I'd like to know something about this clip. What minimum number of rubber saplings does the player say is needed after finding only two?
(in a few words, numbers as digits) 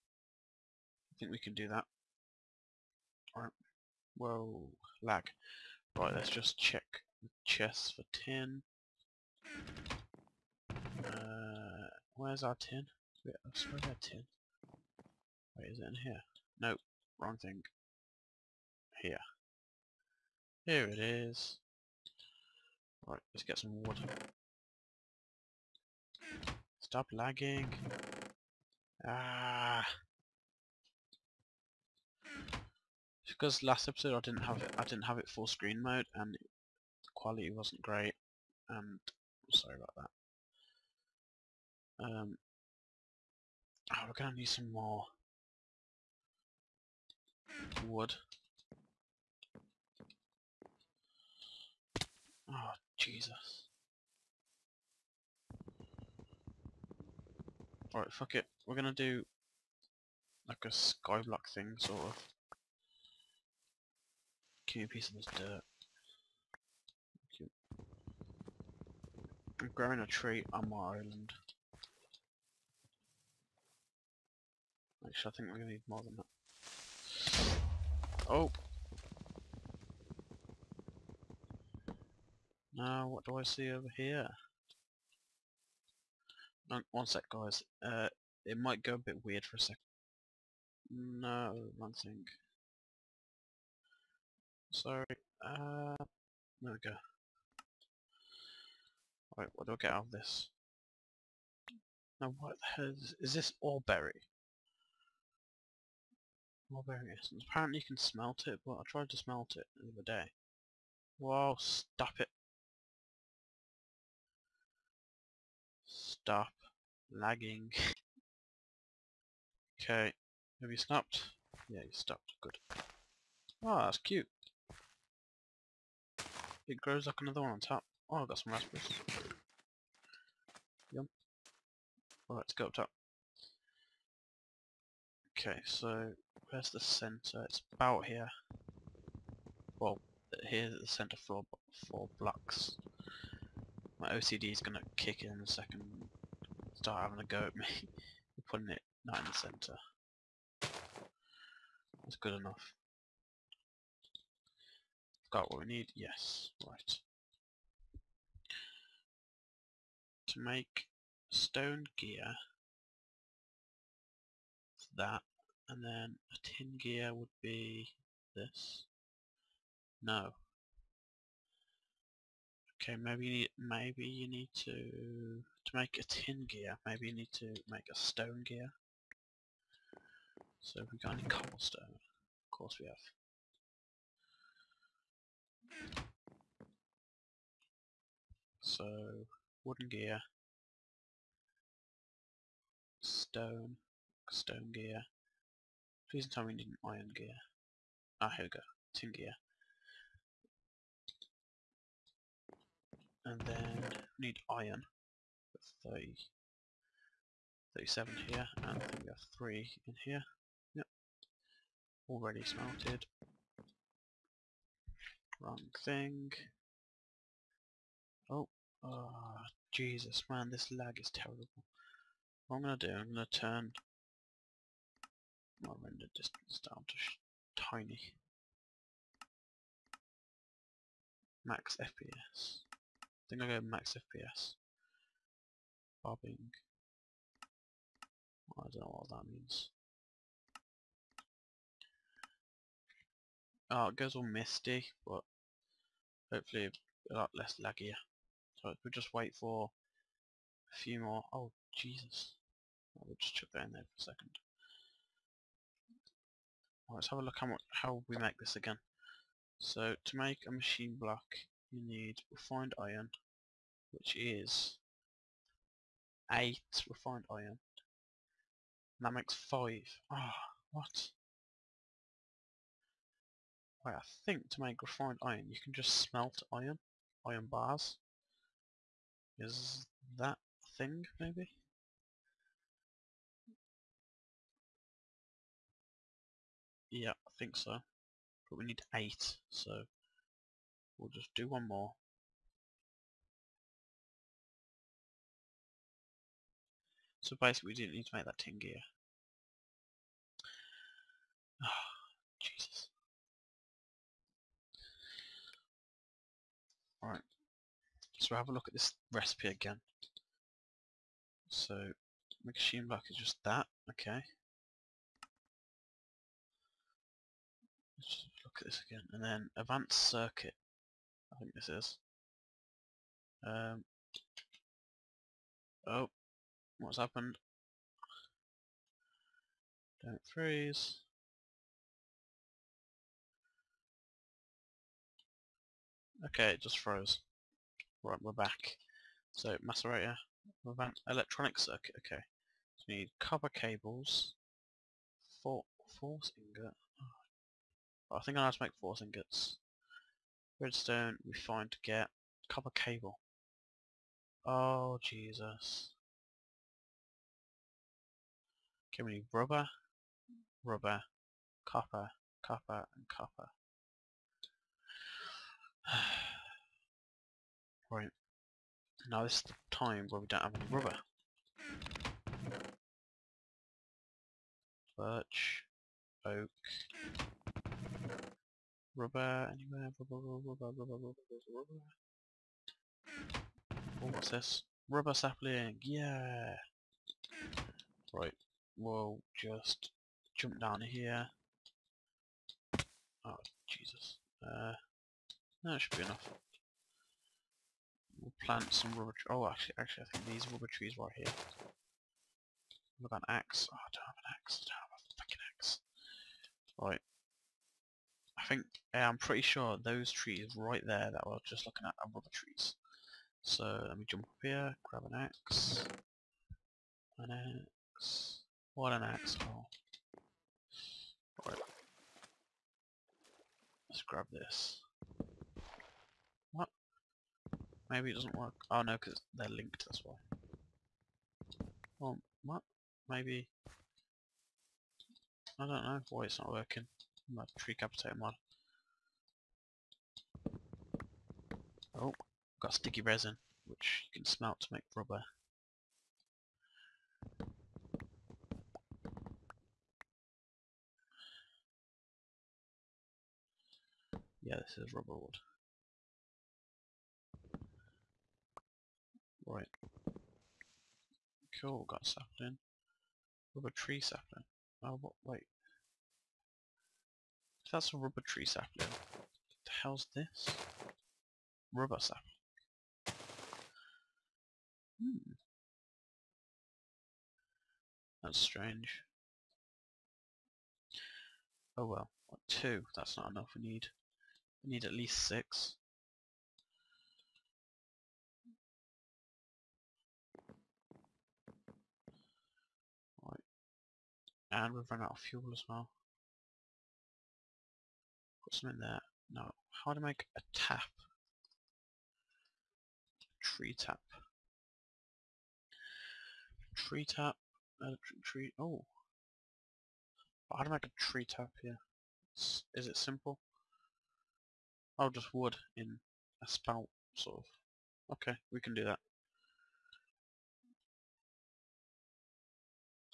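6.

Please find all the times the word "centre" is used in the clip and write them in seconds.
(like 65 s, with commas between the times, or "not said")
136 s, 140 s, 149 s.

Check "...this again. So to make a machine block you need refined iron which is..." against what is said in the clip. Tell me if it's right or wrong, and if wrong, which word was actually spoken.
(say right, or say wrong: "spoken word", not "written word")
right.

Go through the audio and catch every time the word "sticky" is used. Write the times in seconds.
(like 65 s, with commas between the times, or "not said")
442 s.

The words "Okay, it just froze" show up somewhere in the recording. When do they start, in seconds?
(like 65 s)
336 s.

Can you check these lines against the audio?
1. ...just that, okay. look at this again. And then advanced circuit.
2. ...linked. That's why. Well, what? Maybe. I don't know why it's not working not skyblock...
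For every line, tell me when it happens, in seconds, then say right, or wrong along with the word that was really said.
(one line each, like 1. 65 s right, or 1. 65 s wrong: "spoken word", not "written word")
1. 313 s right
2. 429 s wrong: "trick", not "skyblock".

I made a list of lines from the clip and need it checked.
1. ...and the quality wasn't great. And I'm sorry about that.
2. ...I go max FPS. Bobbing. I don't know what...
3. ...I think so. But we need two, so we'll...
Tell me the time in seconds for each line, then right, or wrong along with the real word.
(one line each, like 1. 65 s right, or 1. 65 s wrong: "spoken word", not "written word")
1. 36 s right
2. 233 s right
3. 287 s wrong: "eight", not "two".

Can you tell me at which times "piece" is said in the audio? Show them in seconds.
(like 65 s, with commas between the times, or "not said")
64 s.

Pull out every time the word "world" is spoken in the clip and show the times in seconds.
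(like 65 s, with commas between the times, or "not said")
not said.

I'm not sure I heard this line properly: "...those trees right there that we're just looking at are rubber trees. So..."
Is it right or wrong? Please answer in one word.
right.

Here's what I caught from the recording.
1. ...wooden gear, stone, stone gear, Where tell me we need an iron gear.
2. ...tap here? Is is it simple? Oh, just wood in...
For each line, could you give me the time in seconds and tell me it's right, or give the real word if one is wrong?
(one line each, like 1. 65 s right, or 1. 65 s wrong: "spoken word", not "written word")
1. 189 s wrong: "Please", not "Where"
2. 511 s right.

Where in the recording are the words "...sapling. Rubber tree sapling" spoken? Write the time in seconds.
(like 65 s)
462 s.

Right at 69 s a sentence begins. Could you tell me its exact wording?
I'm growing a tree on my island.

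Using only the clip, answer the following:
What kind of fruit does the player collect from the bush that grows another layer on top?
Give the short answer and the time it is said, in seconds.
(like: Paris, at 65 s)
raspberries, at 128 s.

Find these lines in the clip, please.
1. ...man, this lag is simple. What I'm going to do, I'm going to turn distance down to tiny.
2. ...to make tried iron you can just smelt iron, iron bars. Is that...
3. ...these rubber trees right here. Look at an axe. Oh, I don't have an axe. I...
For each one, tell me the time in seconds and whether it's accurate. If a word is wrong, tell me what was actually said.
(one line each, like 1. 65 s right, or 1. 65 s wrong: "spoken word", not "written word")
1. 220 s wrong: "terrible", not "simple"
2. 274 s wrong: "refined", not "tried"
3. 400 s right.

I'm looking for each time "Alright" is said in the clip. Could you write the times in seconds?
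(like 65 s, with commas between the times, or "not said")
3 s, 57 s, 99 s, 132 s, 307 s.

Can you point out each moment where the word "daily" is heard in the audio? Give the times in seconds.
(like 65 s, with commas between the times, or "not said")
not said.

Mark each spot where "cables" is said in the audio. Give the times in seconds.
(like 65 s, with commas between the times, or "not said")
343 s, 352 s.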